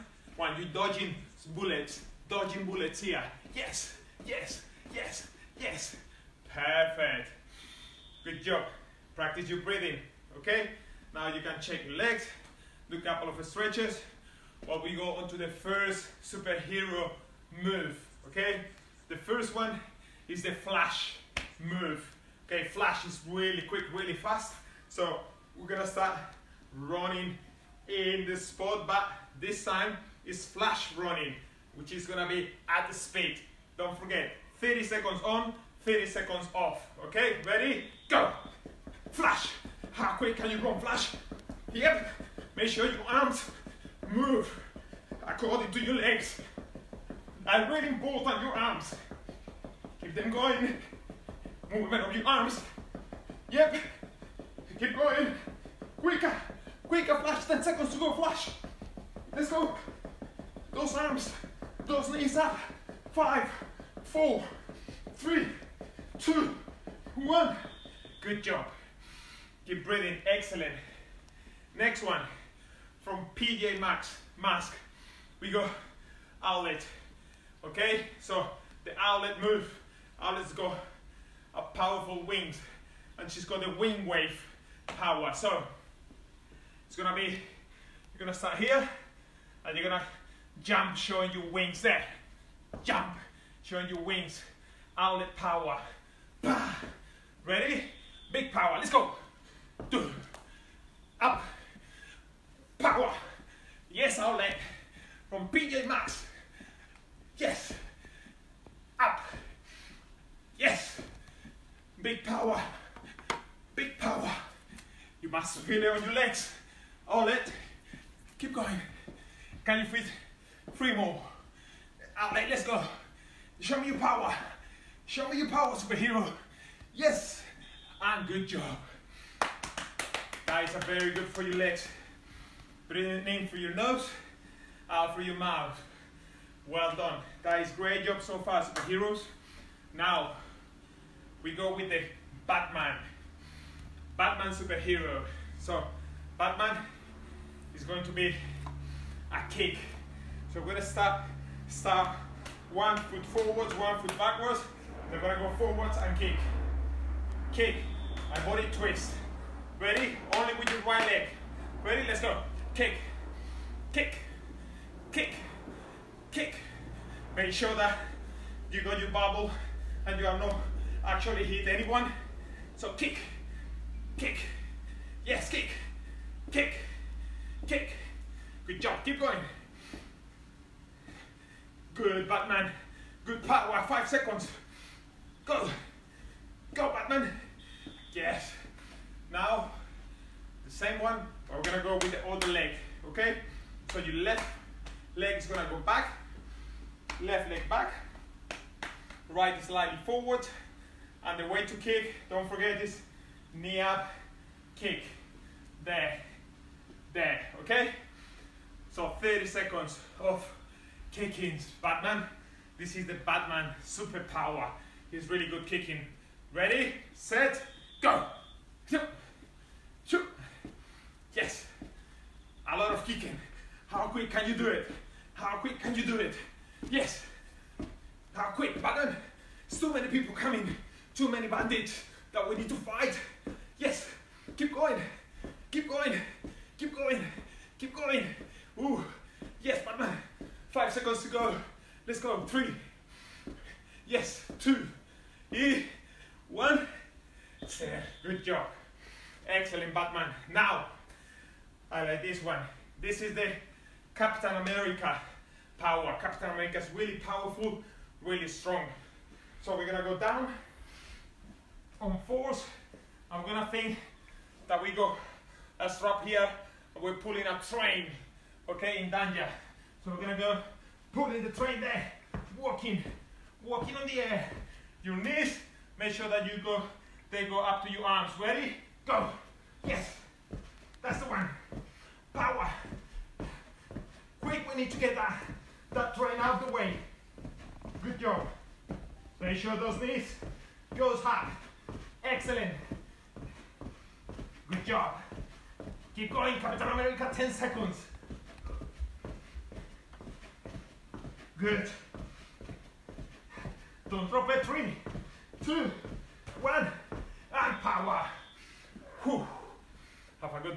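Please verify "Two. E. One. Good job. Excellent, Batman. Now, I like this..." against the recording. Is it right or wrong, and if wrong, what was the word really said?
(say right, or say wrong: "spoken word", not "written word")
right.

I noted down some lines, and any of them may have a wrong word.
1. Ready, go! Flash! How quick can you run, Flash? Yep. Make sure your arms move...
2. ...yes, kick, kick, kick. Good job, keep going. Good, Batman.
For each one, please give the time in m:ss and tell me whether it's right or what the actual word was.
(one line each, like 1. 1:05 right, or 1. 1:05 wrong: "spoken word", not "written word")
1. 0:37 right
2. 2:55 right.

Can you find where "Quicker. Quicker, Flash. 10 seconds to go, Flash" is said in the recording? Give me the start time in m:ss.
0:55.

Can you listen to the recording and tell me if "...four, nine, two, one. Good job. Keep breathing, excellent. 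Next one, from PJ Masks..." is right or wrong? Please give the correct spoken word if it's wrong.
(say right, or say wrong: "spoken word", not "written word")
wrong: "three", not "nine".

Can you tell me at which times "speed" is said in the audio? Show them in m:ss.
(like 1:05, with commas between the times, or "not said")
0:32.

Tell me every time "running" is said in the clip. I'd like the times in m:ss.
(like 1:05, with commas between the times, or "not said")
0:26, 0:30.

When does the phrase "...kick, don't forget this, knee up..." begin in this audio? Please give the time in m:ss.
3:21.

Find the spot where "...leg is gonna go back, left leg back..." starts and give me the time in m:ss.
3:15.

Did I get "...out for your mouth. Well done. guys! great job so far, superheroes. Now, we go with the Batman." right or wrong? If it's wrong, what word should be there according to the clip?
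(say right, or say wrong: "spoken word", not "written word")
right.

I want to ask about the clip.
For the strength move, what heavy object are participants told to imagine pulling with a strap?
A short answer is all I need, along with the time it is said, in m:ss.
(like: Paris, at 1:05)
a train, at 4:31.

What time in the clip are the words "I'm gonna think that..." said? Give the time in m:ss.
4:23.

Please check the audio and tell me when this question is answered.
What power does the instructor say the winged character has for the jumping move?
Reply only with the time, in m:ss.
1:23.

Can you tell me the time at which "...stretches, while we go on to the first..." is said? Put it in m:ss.
0:13.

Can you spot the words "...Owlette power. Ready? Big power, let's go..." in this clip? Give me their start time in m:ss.
1:34.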